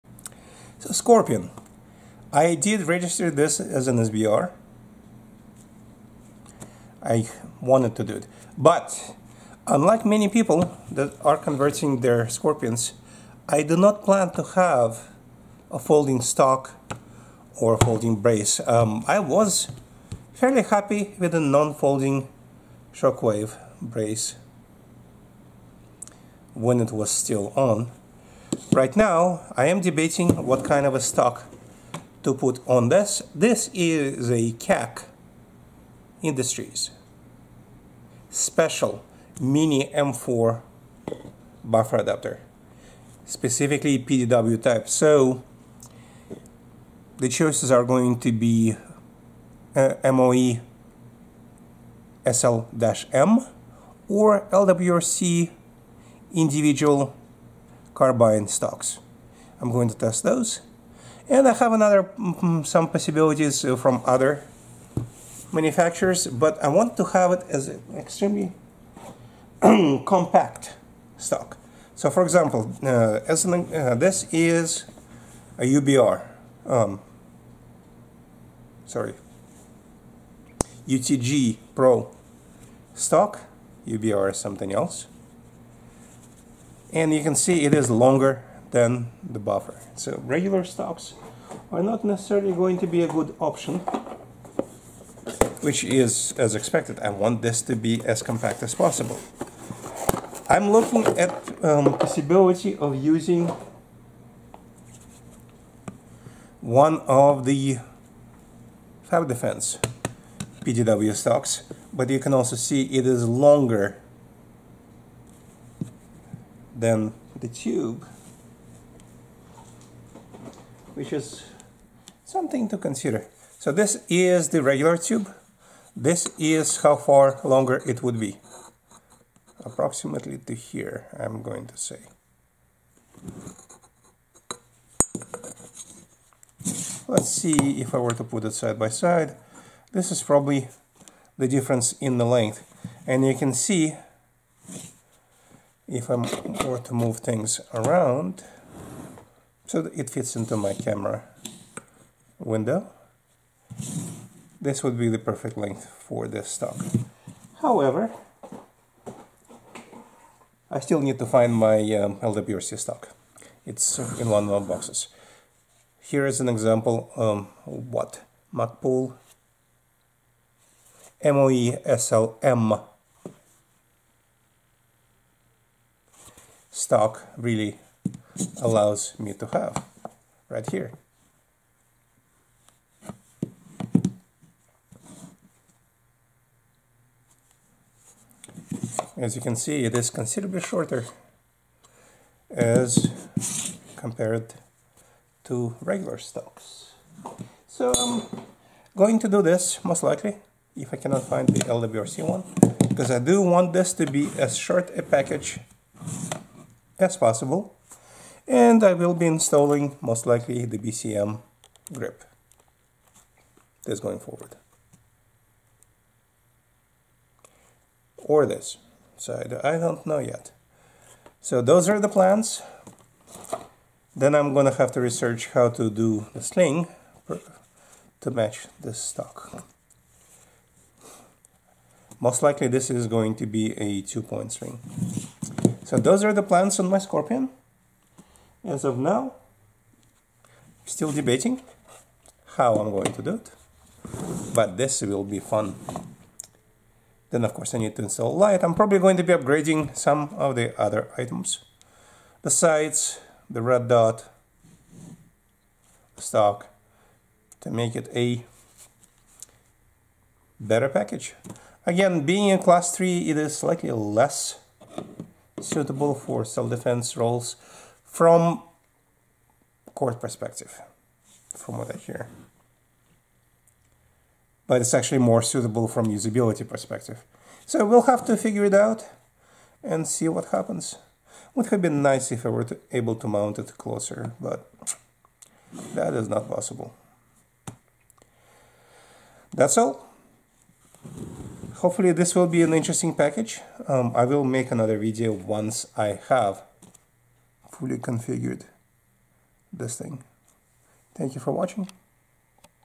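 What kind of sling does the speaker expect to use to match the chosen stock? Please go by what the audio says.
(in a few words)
two-point sling.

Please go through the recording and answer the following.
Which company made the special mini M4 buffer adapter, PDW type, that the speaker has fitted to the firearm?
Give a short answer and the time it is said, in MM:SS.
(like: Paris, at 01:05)
CAC Industries, at 00:34.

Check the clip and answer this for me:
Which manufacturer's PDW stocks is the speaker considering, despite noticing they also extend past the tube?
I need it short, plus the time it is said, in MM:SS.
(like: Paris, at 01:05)
Fab Defense, at 01:49.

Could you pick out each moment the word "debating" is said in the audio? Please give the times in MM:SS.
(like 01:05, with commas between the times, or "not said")
00:29, 04:01.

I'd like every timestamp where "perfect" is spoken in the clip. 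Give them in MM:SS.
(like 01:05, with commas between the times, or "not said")
02:35.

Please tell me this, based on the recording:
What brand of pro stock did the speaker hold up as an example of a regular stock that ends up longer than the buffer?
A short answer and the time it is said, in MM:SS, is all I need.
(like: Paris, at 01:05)
UTG, at 01:20.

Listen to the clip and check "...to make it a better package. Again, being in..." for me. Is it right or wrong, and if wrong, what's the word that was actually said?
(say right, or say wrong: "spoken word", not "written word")
right.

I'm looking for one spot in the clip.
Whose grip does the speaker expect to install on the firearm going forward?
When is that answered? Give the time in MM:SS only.
03:30.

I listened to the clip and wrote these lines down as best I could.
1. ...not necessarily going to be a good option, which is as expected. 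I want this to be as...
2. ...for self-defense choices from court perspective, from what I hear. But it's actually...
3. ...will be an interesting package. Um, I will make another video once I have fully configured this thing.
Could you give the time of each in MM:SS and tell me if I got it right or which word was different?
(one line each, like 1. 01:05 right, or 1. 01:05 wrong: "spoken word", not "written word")
1. 01:31 right
2. 04:26 wrong: "roles", not "choices"
3. 04:52 right.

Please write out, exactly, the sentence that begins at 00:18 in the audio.
Um, I was fairly happy with a non-folding shockwave brace when it was still on.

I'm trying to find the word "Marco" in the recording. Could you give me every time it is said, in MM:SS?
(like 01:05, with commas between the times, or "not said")
not said.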